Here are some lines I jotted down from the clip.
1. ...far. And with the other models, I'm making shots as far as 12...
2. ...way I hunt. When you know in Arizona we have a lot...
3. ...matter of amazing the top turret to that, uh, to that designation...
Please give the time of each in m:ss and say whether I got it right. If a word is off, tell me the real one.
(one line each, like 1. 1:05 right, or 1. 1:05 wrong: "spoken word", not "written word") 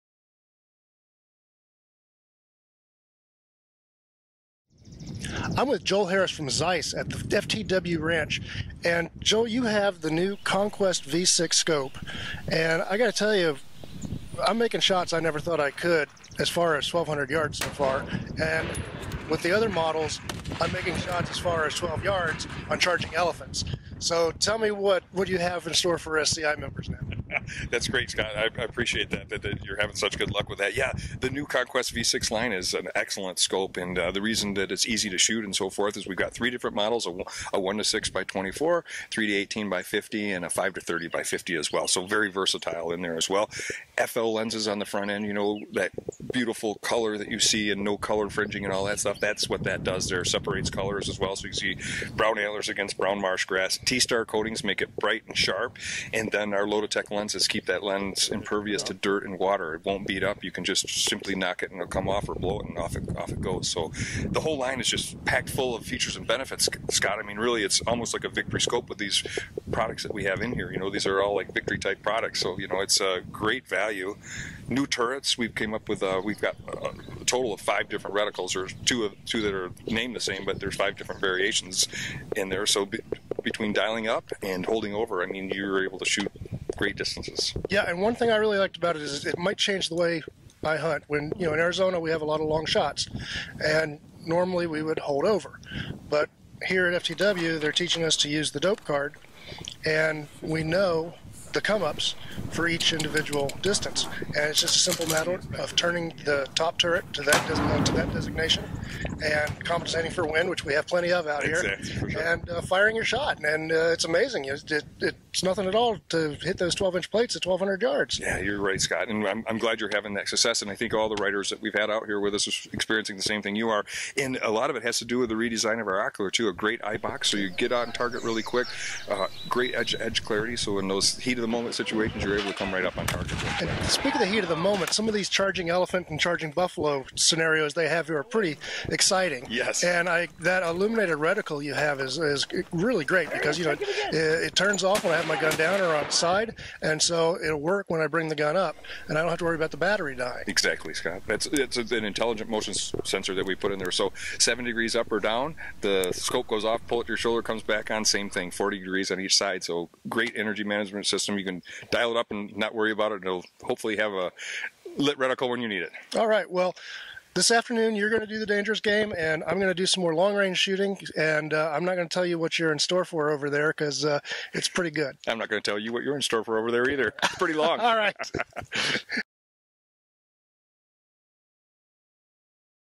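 1. 0:17 right
2. 1:29 right
3. 1:45 wrong: "turning", not "amazing".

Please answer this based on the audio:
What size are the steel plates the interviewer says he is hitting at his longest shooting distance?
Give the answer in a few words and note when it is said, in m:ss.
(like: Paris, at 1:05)
12 inch, at 1:56.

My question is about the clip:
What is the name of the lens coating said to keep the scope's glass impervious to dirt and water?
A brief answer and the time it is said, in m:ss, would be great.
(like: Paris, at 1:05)
LotuTec, at 0:56.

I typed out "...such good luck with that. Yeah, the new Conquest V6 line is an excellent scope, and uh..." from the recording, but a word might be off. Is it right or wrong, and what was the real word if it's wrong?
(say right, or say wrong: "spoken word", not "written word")
right.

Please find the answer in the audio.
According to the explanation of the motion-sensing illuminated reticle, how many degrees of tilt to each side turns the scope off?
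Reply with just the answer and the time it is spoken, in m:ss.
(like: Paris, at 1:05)
40 degrees, at 2:38.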